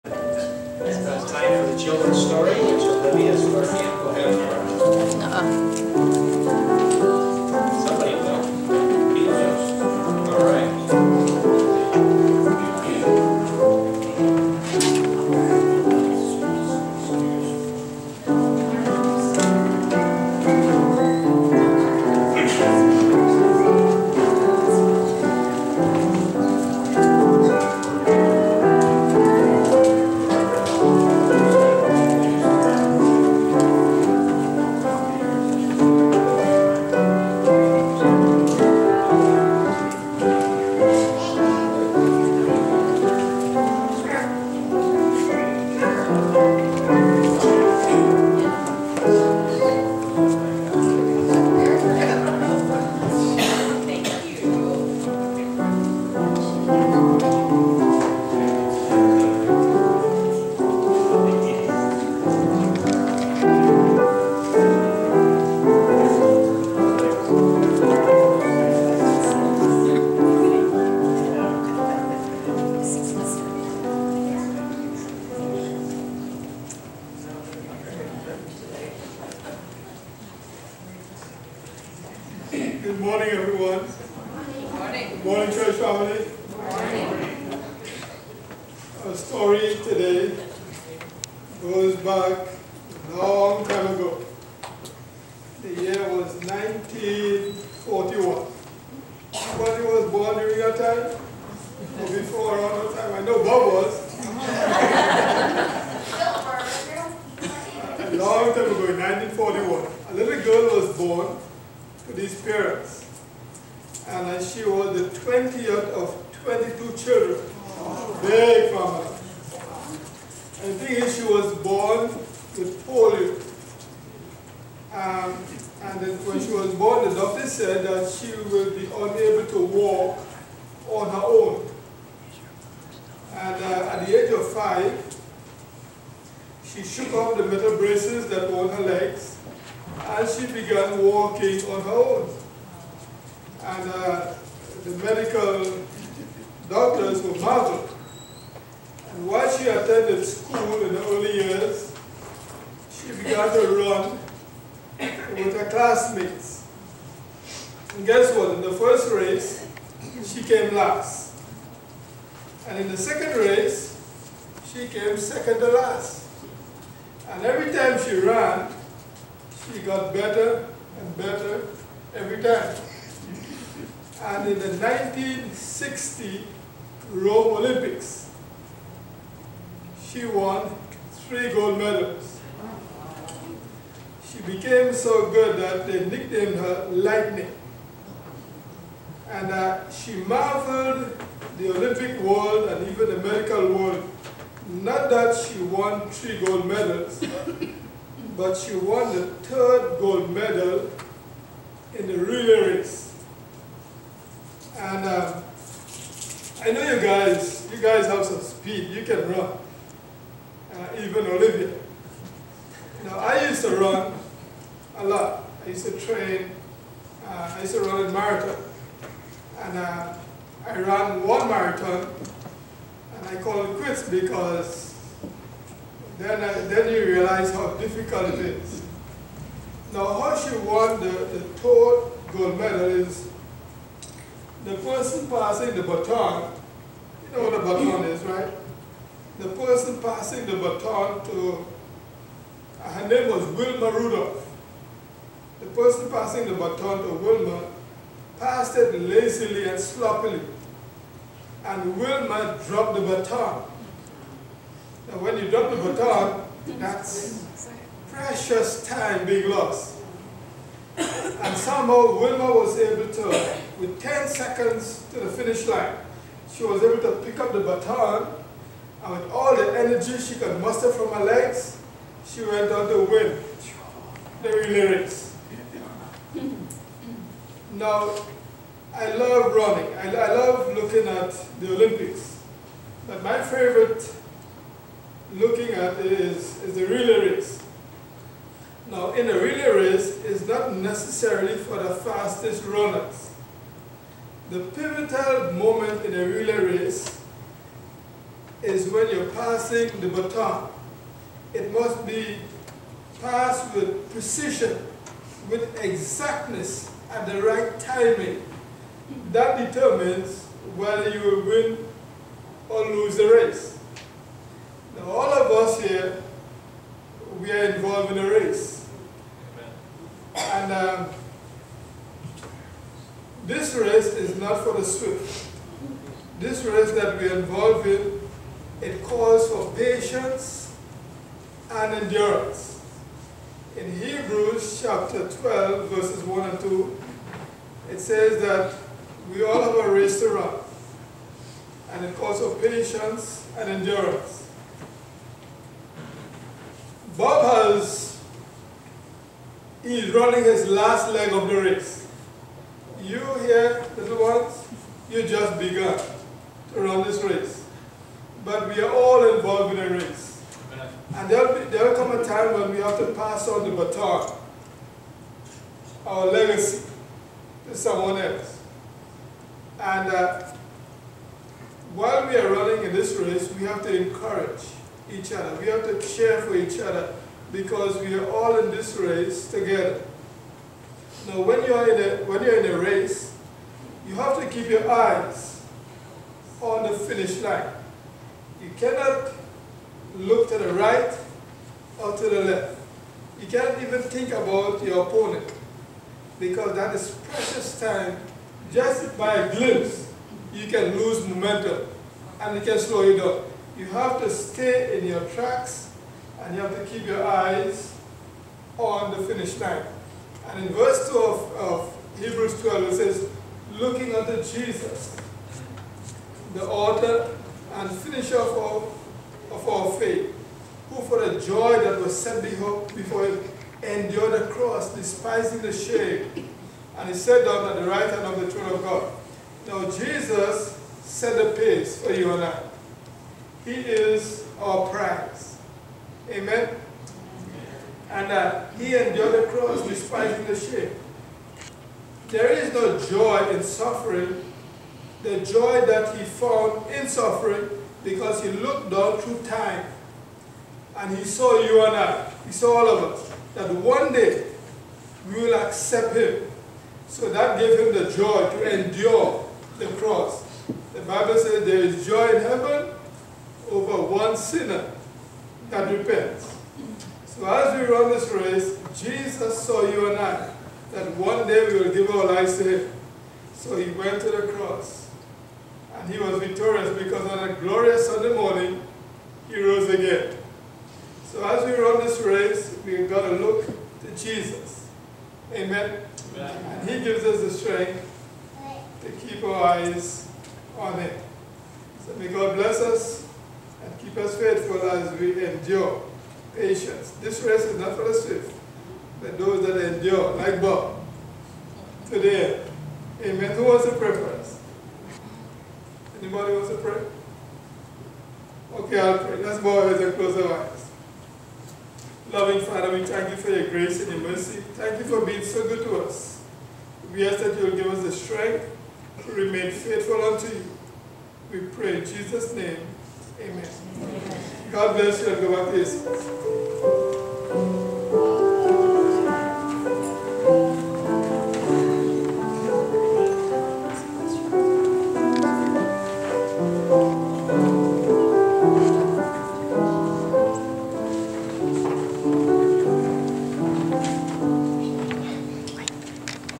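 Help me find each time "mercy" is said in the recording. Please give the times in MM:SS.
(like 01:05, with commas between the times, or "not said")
08:34.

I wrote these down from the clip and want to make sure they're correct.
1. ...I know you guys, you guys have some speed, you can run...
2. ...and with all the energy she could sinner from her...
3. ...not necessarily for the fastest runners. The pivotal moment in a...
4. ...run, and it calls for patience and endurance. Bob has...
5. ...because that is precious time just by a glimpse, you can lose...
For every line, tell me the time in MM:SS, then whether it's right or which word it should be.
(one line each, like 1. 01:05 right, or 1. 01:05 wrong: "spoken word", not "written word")
1. 03:26 right
2. 04:29 wrong: "muster", not "sinner"
3. 04:50 right
4. 05:40 right
5. 06:36 right.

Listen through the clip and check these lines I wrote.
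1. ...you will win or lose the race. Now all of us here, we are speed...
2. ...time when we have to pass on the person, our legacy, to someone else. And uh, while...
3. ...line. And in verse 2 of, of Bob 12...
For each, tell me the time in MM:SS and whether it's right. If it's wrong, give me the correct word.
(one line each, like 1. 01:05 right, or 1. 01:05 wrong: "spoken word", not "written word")
1. 05:11 wrong: "involved", not "speed"
2. 06:02 wrong: "baton", not "person"
3. 06:49 wrong: "Hebrews", not "Bob".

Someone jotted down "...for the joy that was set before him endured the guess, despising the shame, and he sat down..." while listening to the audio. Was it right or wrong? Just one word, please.
wrong.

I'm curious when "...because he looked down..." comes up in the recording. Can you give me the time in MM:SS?
07:28.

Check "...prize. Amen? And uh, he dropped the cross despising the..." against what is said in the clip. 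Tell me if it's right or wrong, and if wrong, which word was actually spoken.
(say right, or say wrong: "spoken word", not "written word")
wrong: "endured", not "dropped".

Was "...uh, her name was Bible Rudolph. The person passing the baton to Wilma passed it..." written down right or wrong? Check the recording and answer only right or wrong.
wrong.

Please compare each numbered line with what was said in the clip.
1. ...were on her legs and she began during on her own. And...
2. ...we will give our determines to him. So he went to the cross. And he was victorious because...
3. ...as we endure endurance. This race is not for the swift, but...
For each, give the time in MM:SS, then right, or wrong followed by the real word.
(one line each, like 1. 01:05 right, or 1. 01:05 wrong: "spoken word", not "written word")
1. 02:18 wrong: "walking", not "during"
2. 07:51 wrong: "lives", not "determines"
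3. 08:14 wrong: "patience", not "endurance".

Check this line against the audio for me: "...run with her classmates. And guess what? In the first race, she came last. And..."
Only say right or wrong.
right.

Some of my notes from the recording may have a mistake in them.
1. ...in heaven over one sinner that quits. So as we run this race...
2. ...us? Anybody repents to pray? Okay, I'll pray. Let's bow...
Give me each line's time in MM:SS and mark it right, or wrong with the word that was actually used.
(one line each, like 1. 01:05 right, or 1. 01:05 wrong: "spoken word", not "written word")
1. 07:42 wrong: "repents", not "quits"
2. 08:24 wrong: "wants", not "repents".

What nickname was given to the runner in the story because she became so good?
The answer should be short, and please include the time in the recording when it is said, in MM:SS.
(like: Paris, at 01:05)
Lightning, at 03:06.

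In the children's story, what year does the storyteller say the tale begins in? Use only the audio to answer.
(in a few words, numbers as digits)
1941.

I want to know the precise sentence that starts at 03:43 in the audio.
I call it quits because then, I, then you realize how difficult it is.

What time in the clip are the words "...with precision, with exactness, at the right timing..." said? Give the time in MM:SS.
05:03.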